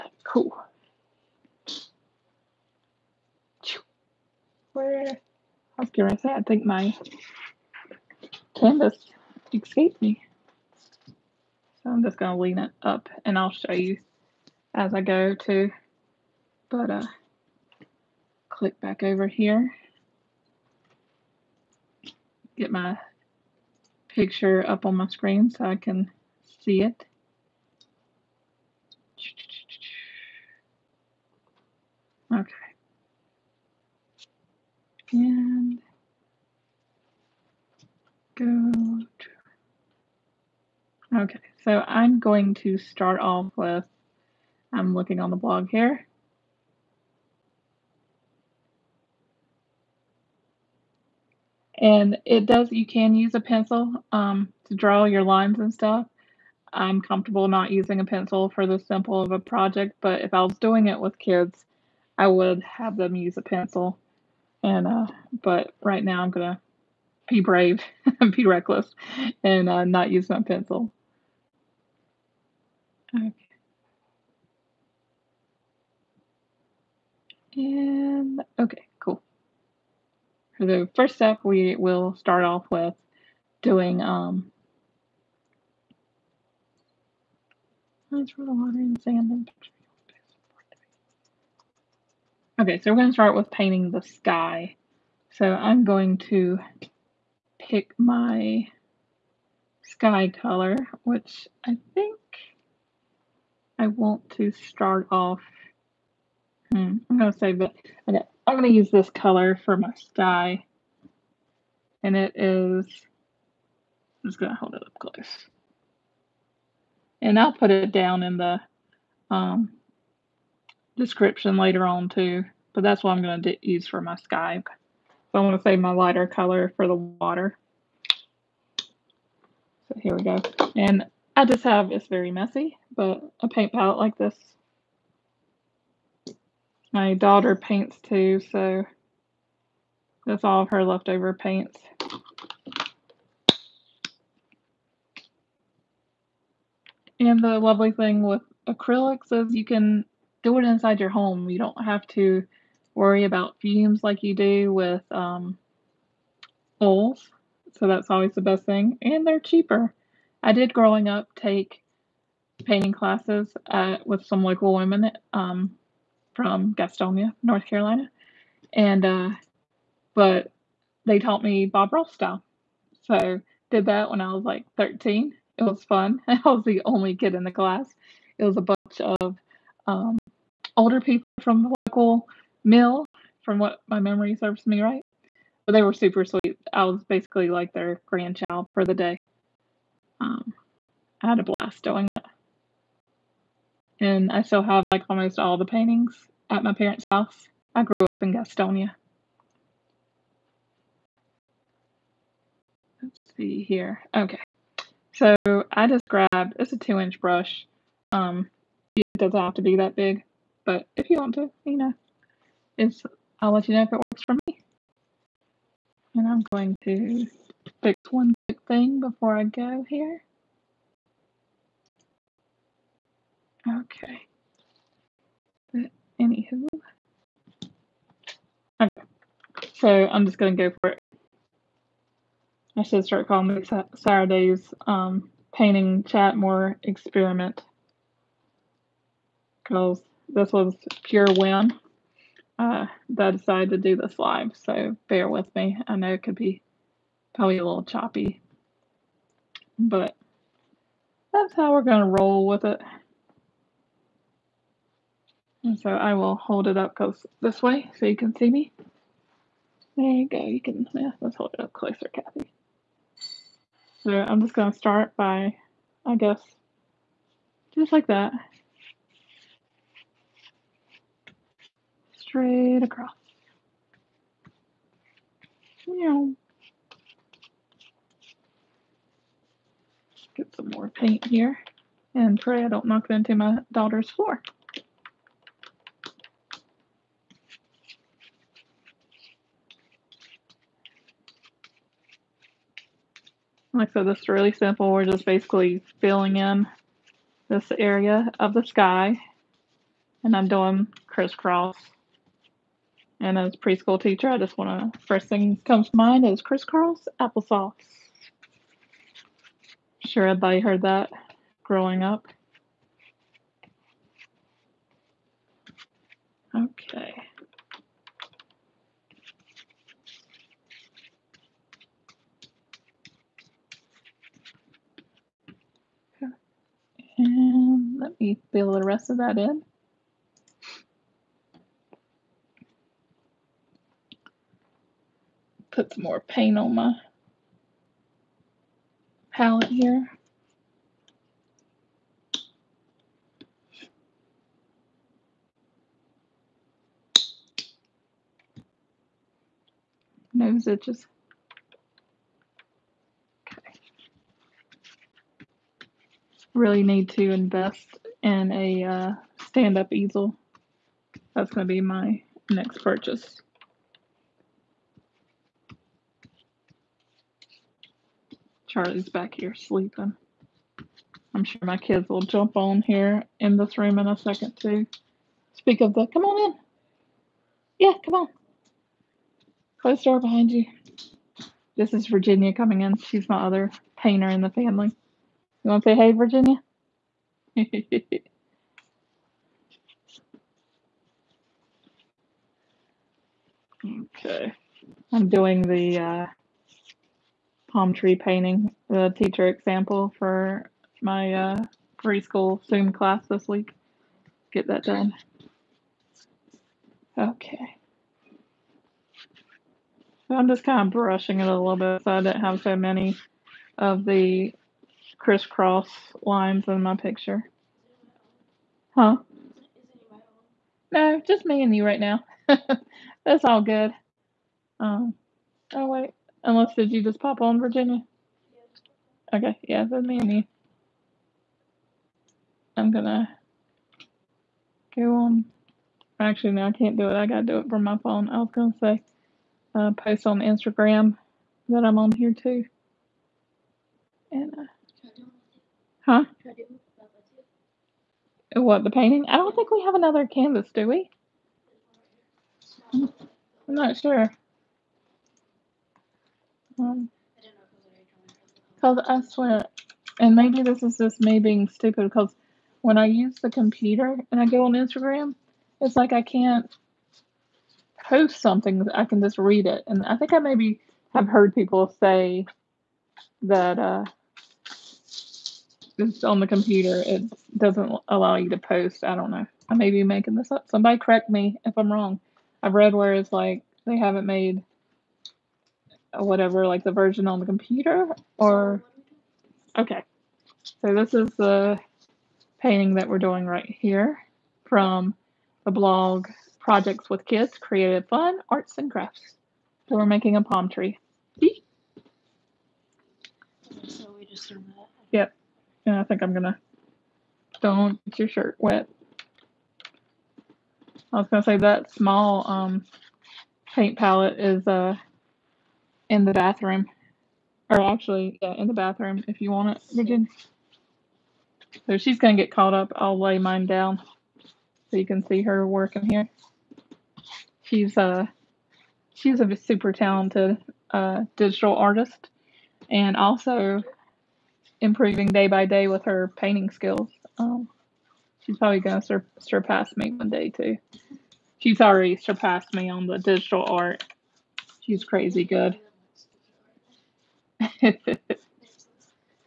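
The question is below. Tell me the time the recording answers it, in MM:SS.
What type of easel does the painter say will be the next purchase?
05:59.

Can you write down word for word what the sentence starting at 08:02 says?
I've read where it's like they haven't made whatever, like the version on the computer?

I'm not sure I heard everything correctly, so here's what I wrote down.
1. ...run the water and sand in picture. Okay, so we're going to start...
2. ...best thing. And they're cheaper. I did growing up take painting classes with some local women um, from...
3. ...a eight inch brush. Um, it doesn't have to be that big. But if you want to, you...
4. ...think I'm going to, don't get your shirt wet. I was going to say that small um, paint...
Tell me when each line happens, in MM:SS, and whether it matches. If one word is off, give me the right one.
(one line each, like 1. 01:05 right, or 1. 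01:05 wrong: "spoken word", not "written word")
1. 01:28 right
2. 02:38 right
3. 03:26 wrong: "two", not "eight"
4. 08:26 right.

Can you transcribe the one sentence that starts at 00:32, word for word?
Okay and go to, okay, so I'm going to start off with, I'm looking on the blog here.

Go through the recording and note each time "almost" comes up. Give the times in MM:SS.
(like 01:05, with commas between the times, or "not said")
03:15.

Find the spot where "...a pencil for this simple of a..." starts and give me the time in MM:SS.
00:57.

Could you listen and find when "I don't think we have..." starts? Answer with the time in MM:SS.
07:29.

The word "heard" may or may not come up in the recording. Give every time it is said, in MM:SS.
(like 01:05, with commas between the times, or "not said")
05:10, 07:51.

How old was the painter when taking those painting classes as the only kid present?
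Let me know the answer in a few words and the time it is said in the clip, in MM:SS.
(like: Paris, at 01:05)
13, at 02:54.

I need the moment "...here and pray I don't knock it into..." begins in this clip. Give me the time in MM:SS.
04:41.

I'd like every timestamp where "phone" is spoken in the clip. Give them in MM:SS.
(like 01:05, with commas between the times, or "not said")
07:17.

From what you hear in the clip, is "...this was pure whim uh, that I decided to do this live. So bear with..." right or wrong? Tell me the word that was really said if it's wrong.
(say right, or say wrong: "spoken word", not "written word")
right.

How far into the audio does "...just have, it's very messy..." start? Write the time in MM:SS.
02:11.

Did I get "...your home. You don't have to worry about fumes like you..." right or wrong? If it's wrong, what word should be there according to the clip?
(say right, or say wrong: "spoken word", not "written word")
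right.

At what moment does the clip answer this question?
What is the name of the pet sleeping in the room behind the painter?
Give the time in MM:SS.
06:08.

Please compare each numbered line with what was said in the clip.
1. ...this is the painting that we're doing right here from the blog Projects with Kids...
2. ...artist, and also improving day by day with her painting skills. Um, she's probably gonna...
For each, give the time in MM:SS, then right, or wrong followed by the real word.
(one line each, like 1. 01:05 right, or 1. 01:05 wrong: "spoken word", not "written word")
1. 08:10 right
2. 08:51 right.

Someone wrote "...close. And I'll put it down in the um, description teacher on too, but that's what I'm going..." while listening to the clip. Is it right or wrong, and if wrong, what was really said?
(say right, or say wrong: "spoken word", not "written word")
wrong: "later", not "teacher".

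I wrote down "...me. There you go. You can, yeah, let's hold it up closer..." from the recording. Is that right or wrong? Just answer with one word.
right.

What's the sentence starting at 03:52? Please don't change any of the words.
I should start calling me Saturday's um, painting chat more experiment.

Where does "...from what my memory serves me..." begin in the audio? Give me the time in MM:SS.
03:03.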